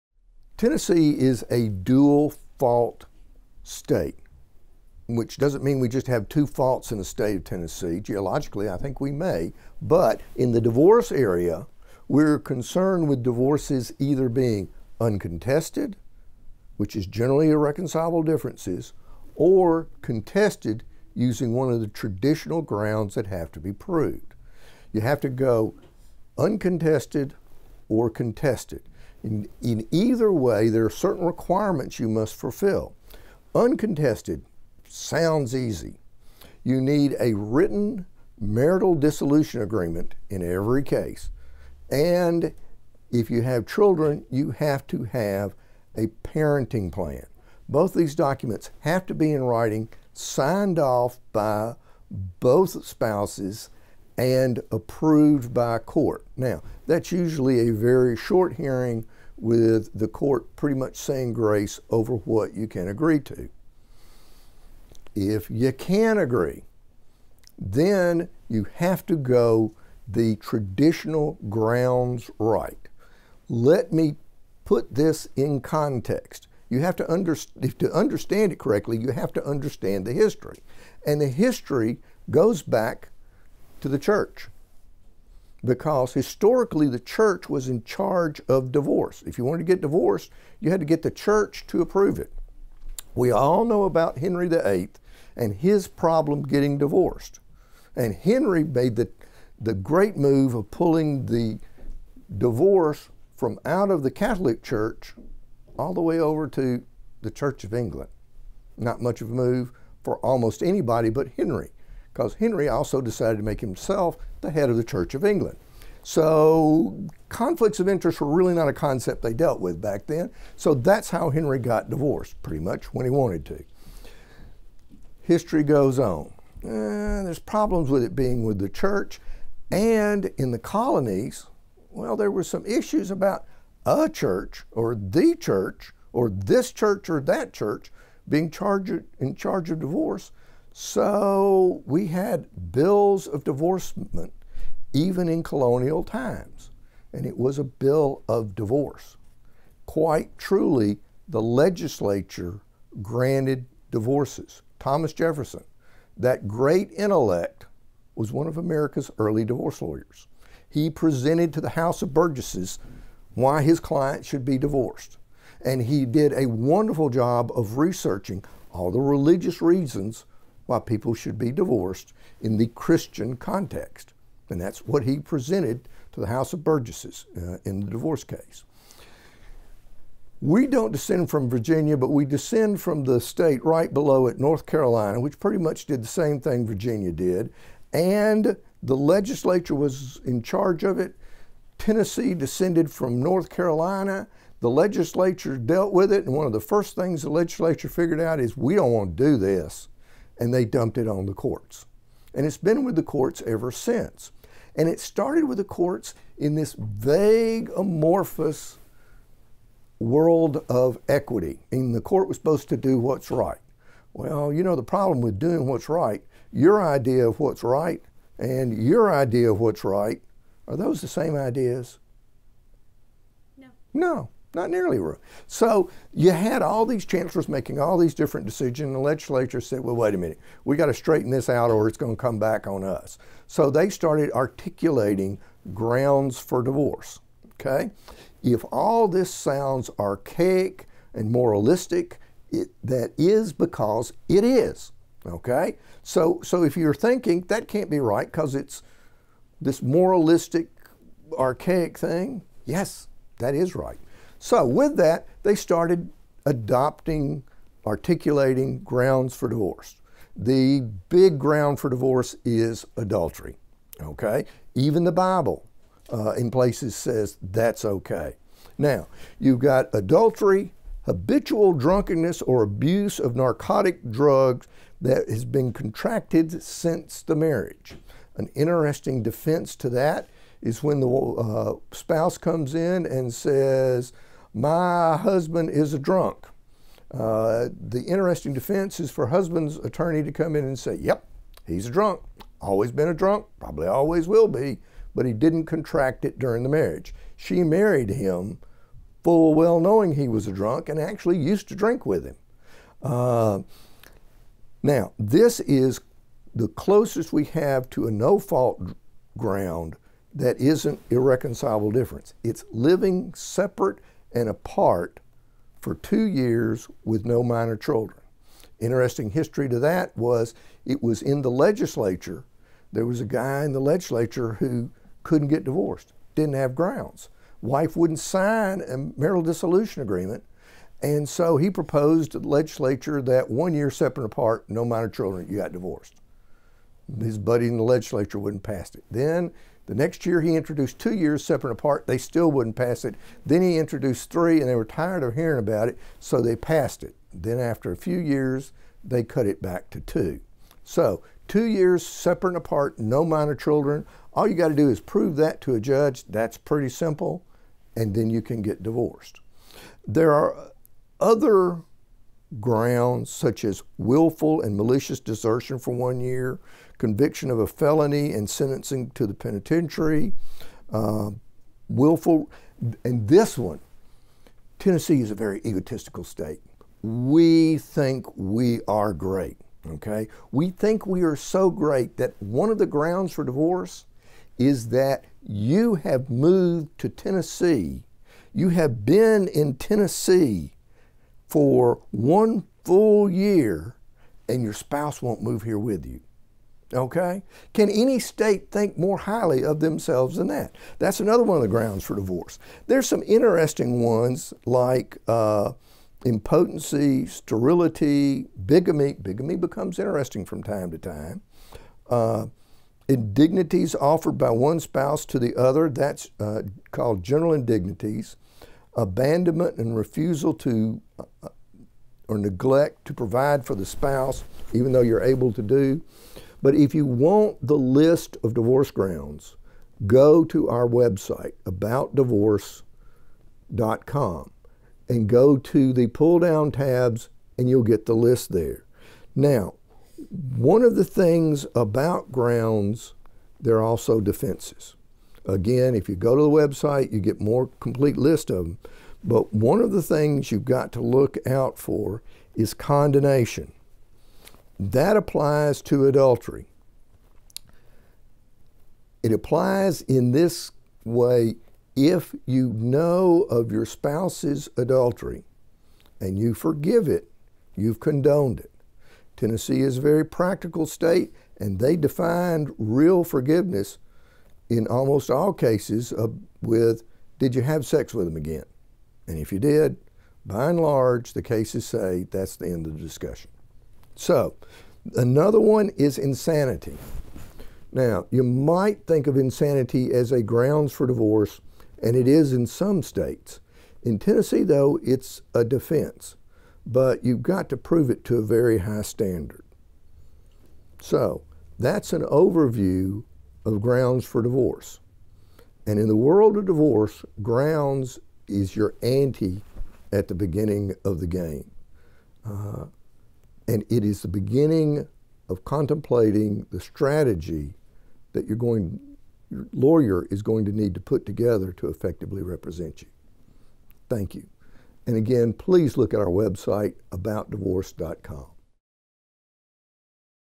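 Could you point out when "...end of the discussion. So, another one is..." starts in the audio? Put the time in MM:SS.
08:02.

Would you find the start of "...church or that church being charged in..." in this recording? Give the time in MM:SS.
02:16.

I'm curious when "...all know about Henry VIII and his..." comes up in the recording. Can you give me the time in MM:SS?
01:33.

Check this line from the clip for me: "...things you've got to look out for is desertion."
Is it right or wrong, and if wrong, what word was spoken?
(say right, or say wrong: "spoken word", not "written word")
wrong: "condonation", not "desertion".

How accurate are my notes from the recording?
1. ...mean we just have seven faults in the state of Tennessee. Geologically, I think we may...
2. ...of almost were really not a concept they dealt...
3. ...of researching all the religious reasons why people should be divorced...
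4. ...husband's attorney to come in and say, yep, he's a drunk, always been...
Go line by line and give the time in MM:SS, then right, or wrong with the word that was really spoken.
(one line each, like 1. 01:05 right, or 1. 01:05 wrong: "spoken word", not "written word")
1. 00:05 wrong: "two", not "seven"
2. 01:57 wrong: "interest", not "almost"
3. 02:47 right
4. 04:49 right.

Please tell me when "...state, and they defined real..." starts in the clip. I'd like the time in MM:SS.
07:50.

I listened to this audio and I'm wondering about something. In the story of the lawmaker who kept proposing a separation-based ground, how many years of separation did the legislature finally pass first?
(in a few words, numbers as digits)
3.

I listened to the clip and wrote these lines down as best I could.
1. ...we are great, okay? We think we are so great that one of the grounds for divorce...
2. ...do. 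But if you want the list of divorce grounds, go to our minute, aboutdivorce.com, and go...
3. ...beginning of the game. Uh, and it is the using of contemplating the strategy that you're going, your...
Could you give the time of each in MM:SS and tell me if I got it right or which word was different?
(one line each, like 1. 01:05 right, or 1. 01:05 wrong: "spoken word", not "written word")
1. 06:18 right
2. 07:05 wrong: "website", not "minute"
3. 08:30 wrong: "beginning", not "using".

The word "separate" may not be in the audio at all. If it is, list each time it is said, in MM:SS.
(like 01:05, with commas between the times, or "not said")
05:13, 05:33, 05:41, 05:52.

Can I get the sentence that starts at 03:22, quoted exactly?
And it's been with the courts ever since.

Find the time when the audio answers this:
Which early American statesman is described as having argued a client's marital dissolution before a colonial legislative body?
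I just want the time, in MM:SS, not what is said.
02:34.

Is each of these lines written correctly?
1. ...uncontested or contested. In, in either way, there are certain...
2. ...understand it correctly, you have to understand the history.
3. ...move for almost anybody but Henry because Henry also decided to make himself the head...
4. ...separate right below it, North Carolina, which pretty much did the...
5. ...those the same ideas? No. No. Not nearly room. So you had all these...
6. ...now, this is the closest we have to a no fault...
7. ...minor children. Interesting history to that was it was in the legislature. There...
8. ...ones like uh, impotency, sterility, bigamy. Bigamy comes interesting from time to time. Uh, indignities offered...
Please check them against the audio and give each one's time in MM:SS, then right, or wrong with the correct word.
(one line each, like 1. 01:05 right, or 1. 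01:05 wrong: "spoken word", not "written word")
1. 00:26 right
2. 01:17 right
3. 01:49 right
4. 03:03 wrong: "state", not "separate"
5. 03:40 right
6. 05:04 right
7. 05:17 right
8. 06:44 wrong: "becomes", not "comes".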